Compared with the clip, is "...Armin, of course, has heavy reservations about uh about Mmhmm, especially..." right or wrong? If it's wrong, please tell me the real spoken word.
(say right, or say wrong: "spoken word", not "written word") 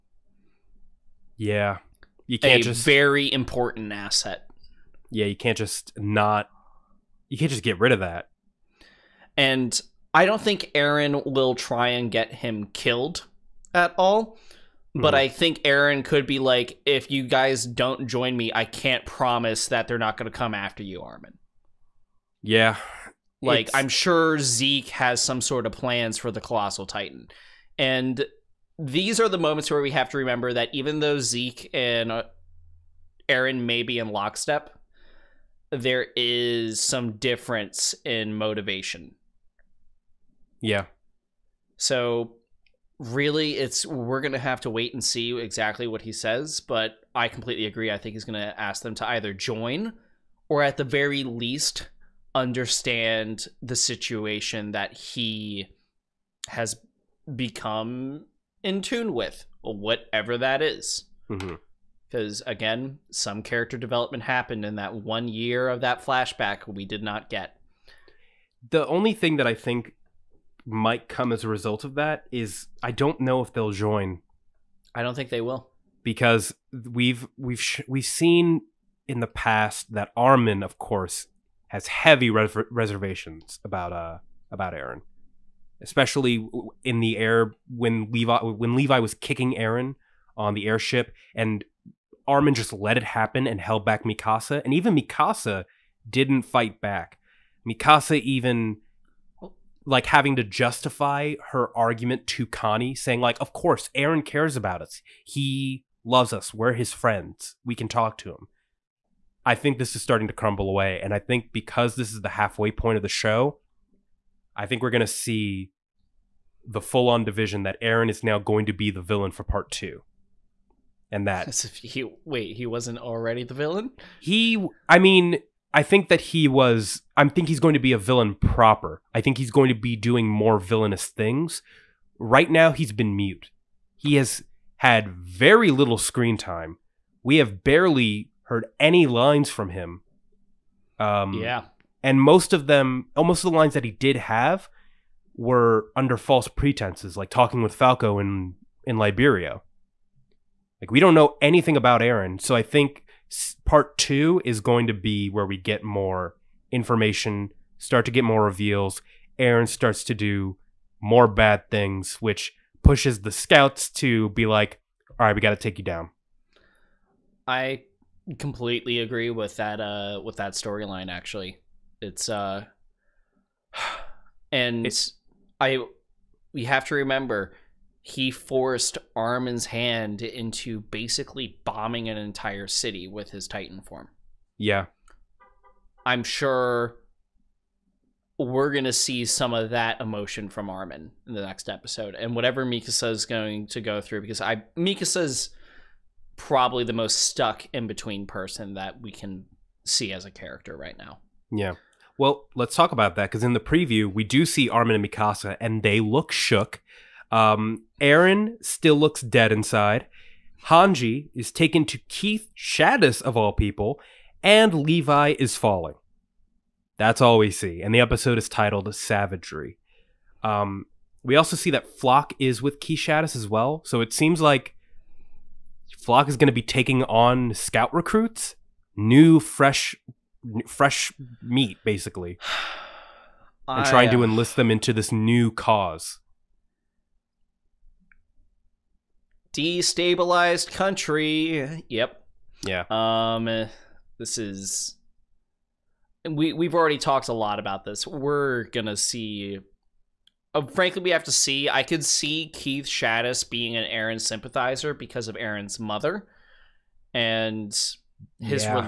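wrong: "Eren", not "Mmhmm".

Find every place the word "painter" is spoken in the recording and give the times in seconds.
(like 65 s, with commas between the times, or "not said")
not said.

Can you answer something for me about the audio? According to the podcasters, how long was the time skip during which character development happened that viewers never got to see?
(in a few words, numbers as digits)
one year.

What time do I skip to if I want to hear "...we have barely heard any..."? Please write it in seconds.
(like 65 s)
137 s.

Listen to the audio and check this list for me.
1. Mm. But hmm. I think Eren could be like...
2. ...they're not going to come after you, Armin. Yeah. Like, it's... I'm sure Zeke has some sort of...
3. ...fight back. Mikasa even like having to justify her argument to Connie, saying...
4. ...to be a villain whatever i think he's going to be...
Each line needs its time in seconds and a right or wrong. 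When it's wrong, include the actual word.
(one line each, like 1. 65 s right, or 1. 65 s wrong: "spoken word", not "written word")
1. 14 s right
2. 19 s right
3. 96 s right
4. 127 s wrong: "proper", not "whatever".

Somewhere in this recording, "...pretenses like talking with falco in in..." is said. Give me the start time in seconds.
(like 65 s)
146 s.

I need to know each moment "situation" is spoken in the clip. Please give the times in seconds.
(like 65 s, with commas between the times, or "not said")
53 s.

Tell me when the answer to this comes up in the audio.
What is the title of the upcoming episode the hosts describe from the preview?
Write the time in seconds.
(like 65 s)
218 s.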